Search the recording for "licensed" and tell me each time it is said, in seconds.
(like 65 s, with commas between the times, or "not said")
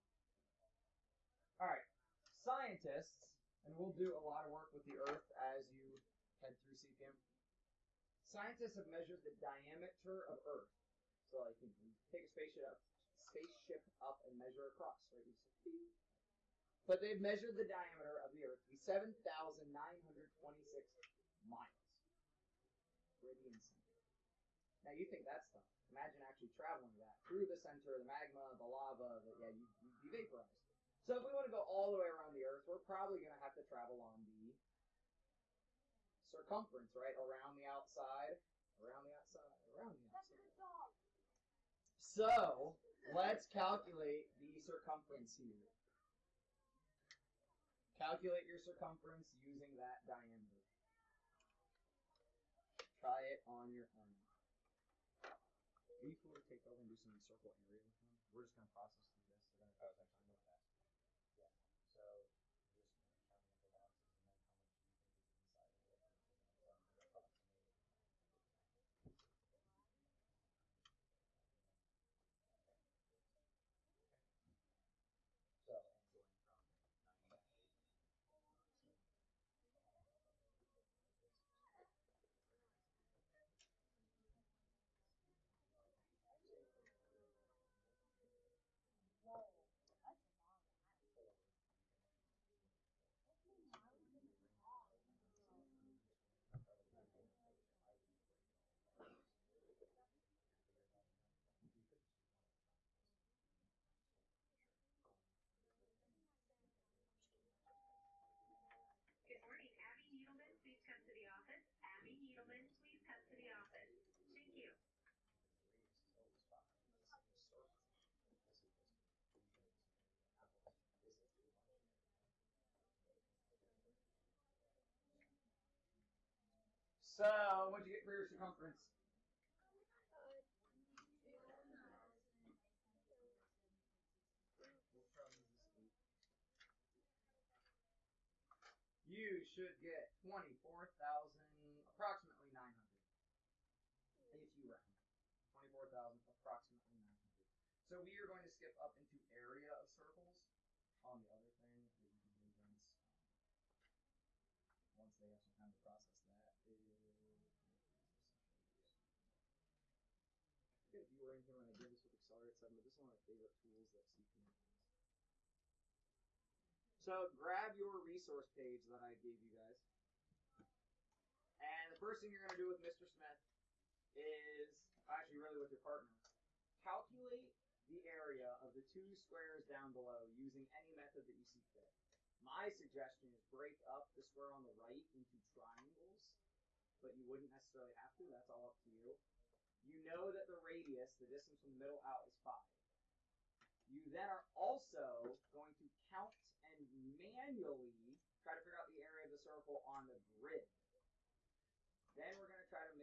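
not said.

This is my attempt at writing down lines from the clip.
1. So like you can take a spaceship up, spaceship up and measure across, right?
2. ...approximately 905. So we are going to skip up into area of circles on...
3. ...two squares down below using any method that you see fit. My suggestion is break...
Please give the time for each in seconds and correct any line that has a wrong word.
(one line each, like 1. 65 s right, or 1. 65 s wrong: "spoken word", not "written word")
1. 11 s right
2. 146 s wrong: "900", not "905"
3. 178 s right.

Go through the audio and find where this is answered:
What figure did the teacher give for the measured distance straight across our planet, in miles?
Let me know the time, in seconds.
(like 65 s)
18 s.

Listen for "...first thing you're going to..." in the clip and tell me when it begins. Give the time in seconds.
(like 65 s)
171 s.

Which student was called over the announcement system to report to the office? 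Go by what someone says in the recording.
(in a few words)
Abby Needleman.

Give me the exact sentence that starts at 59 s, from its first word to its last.
They're going to, actually, i going to ask.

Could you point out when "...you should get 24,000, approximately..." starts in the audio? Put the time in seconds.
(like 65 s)
139 s.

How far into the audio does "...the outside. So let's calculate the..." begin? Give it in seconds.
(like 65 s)
40 s.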